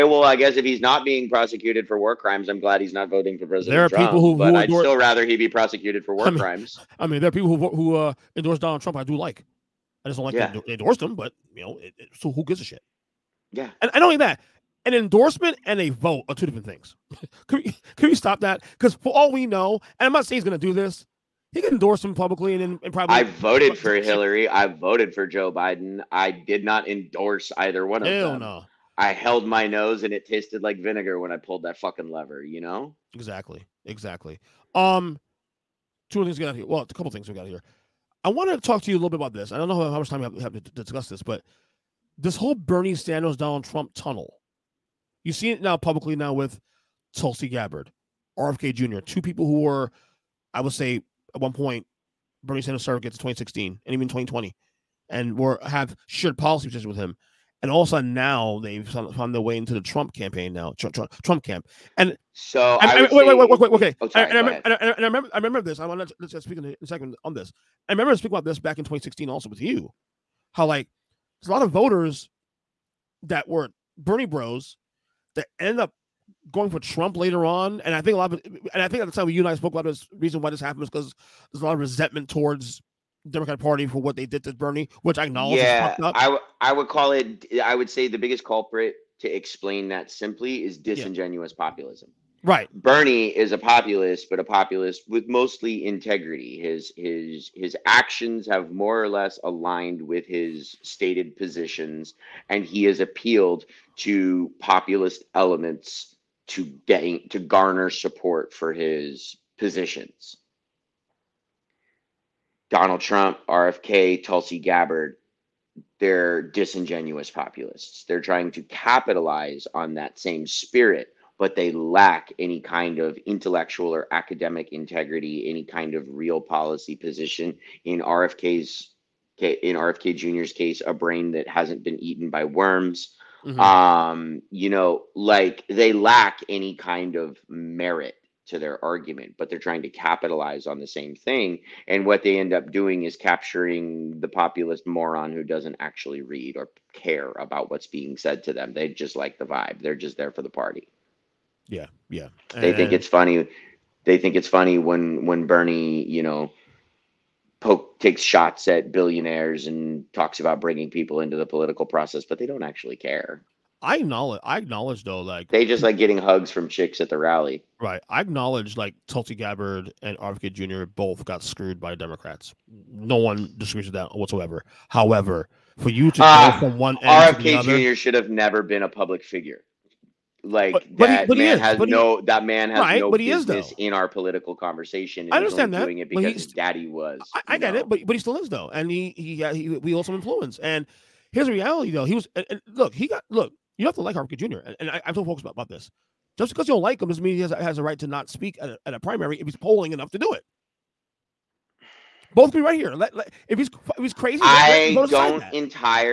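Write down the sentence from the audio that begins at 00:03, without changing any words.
There are Trump, people who, but I'd still rather he be prosecuted for war I mean, crimes.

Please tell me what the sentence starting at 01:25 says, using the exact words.
Yeah, I, w- I would call it.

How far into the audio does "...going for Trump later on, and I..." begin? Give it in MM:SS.
01:16.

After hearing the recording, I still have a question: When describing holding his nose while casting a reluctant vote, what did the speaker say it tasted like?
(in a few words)
Vinegar.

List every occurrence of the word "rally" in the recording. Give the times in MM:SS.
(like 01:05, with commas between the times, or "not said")
02:47.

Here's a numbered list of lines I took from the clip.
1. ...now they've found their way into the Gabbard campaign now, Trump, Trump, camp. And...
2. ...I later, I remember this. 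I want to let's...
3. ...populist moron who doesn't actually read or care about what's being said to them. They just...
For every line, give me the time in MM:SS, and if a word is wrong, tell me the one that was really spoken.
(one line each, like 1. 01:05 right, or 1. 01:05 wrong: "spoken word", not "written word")
1. 00:58 wrong: "Trump", not "Gabbard"
2. 01:04 wrong: "remember", not "later"
3. 02:24 right.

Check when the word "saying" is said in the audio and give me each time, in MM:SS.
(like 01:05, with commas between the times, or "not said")
00:20.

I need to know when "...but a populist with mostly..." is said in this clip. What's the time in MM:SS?
01:34.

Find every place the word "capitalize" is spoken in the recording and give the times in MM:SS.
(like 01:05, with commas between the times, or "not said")
01:58, 02:19.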